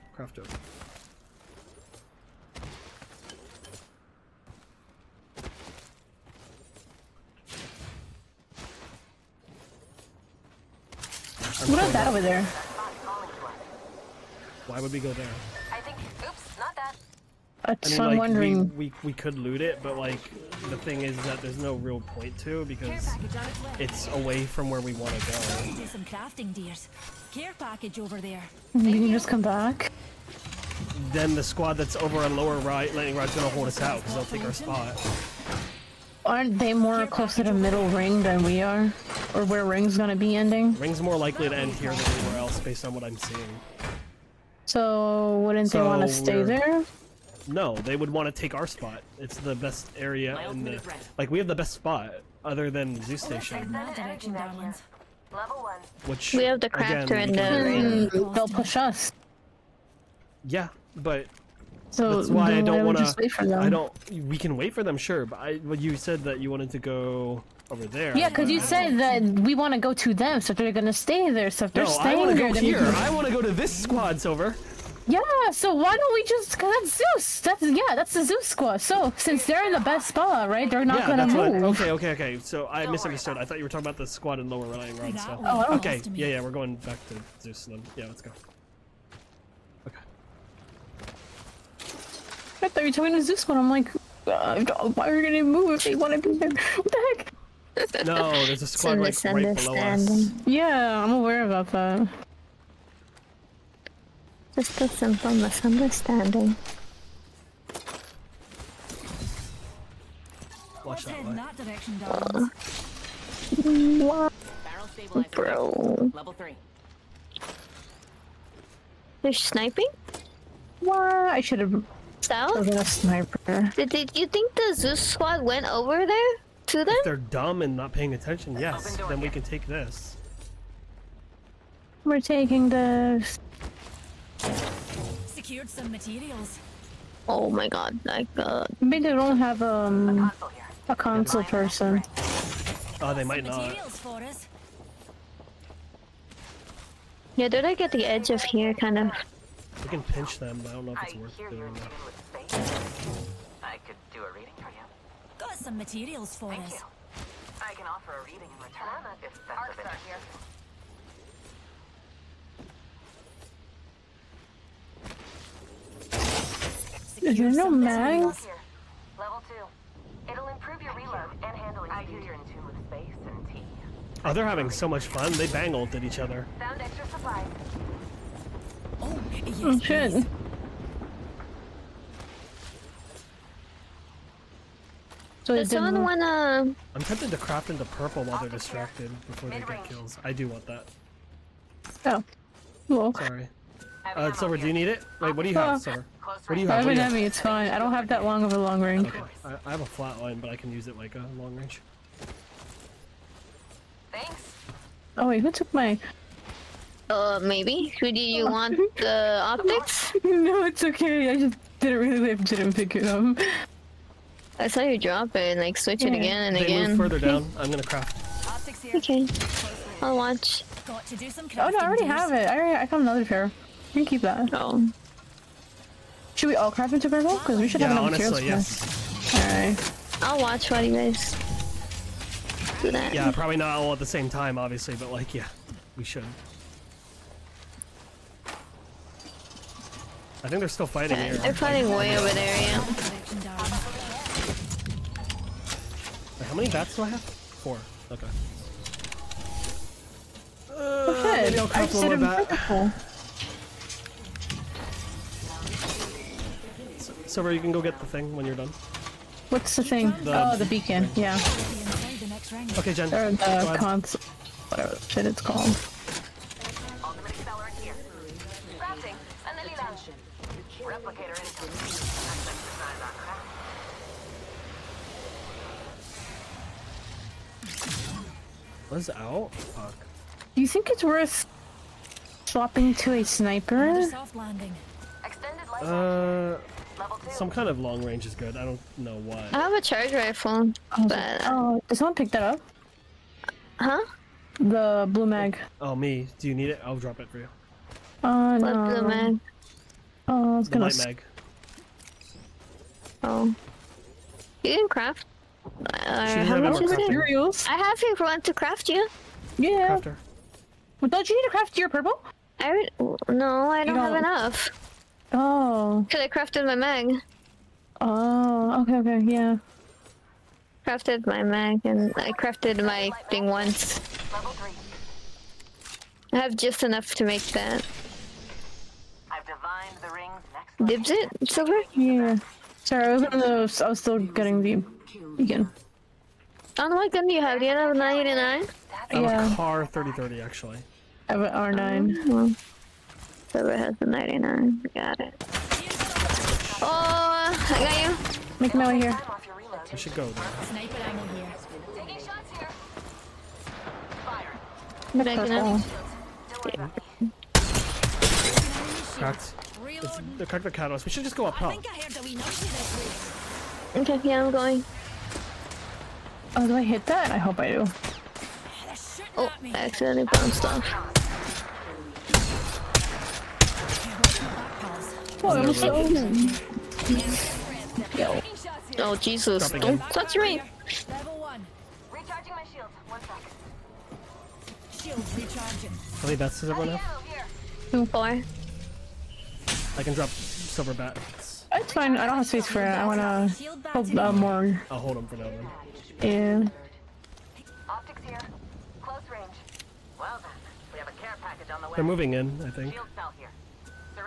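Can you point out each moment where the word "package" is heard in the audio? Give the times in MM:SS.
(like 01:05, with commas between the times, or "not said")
00:27, 06:41.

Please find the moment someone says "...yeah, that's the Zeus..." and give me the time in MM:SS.
01:17.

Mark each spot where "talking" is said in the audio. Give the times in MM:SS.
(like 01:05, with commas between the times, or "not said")
01:23, 01:32.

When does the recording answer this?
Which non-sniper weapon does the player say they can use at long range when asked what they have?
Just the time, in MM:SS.
03:20.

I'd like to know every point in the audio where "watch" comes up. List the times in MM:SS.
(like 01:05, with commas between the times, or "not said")
01:50, 03:40, 03:50.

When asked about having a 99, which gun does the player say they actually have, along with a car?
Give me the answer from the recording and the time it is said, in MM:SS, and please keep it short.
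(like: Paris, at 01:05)
3030, at 05:39.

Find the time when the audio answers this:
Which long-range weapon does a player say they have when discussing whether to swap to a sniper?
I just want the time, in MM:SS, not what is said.
04:49.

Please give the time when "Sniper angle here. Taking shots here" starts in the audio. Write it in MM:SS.
05:50.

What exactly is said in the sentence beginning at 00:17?
That's, I mean, I'm like, wondering.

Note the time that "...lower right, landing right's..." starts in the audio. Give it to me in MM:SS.
00:32.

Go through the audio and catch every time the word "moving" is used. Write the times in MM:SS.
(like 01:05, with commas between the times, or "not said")
06:42.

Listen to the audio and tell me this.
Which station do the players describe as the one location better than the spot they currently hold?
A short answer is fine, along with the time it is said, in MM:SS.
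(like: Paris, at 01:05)
Zeus Station, at 00:53.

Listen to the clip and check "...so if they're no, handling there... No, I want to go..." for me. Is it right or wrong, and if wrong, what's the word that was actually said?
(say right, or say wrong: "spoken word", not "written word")
wrong: "staying", not "handling".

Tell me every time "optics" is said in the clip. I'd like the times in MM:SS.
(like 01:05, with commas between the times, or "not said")
03:29, 06:37.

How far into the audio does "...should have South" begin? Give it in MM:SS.
02:01.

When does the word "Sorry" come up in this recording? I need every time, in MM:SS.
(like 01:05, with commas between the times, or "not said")
03:13, 05:32.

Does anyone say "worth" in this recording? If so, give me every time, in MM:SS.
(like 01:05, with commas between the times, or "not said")
02:31, 04:41.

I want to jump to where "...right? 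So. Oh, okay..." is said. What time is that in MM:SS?
01:24.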